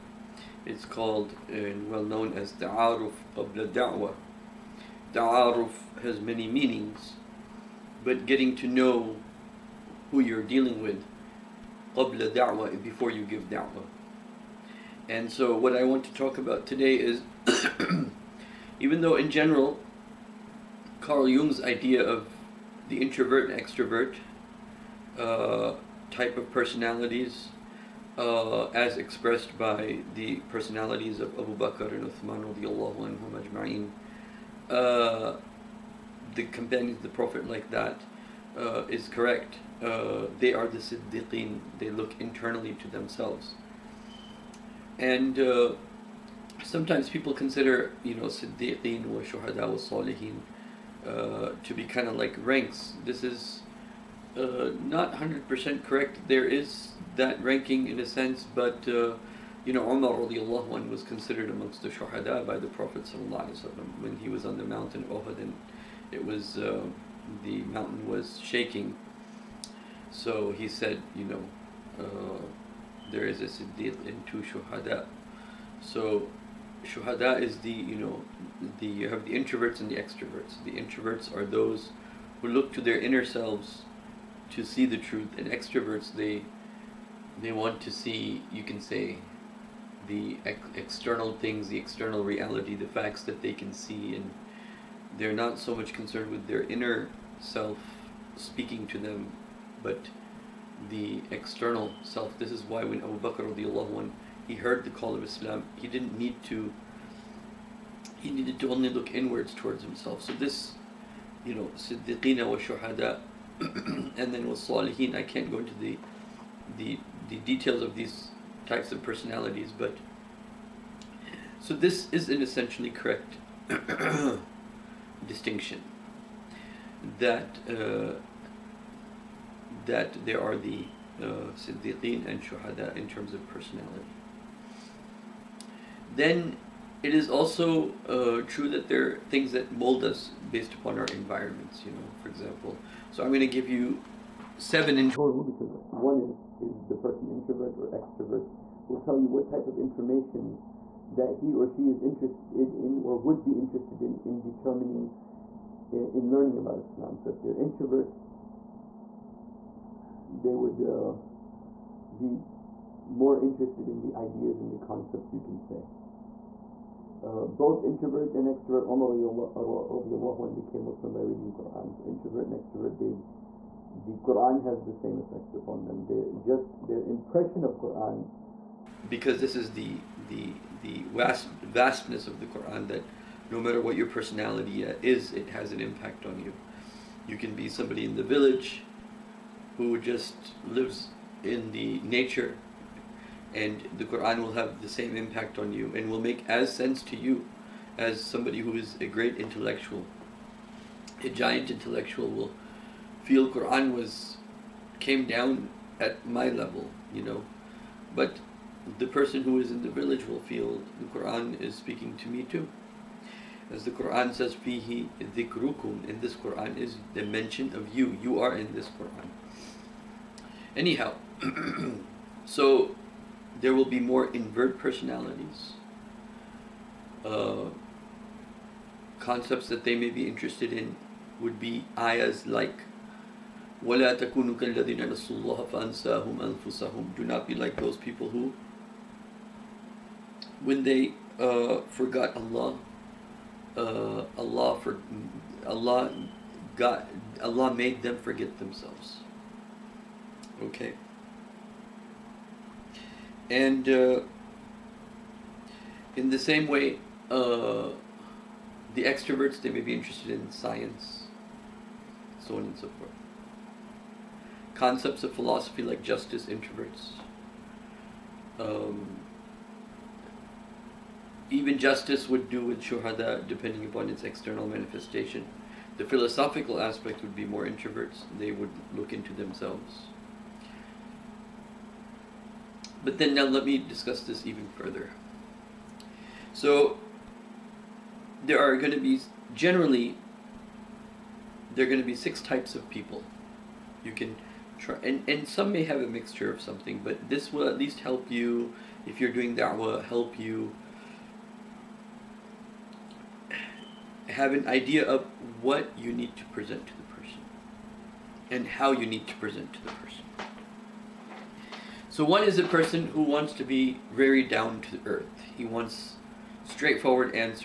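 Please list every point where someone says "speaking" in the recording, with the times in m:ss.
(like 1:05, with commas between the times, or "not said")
1:38, 3:31.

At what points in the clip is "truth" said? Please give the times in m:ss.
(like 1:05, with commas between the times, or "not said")
1:24.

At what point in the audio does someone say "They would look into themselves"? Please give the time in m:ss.
4:38.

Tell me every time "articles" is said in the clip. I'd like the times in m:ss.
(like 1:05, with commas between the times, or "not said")
not said.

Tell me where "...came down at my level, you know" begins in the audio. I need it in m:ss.
3:24.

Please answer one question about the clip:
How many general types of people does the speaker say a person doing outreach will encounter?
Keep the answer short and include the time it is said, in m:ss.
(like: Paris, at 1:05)
6, at 4:52.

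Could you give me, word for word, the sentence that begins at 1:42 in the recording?
This is why when Abu Bakr radiallahu he heard the call of Islam.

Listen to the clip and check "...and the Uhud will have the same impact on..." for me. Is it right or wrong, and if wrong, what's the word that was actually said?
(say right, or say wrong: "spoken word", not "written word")
wrong: "Quran", not "Uhud".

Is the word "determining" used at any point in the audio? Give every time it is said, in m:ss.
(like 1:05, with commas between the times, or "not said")
2:34.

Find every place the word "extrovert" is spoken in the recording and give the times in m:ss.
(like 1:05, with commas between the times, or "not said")
0:23, 1:19, 1:25, 2:27, 2:48, 2:52, 4:19.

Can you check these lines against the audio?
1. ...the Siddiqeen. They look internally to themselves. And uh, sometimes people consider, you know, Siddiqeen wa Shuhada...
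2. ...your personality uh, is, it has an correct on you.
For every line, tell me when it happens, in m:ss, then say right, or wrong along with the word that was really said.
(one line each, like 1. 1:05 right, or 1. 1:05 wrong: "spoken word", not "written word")
1. 0:40 right
2. 3:03 wrong: "impact", not "correct".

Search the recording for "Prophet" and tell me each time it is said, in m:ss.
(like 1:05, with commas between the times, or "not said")
0:37, 1:02.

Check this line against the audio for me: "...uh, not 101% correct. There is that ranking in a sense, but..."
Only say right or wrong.
wrong.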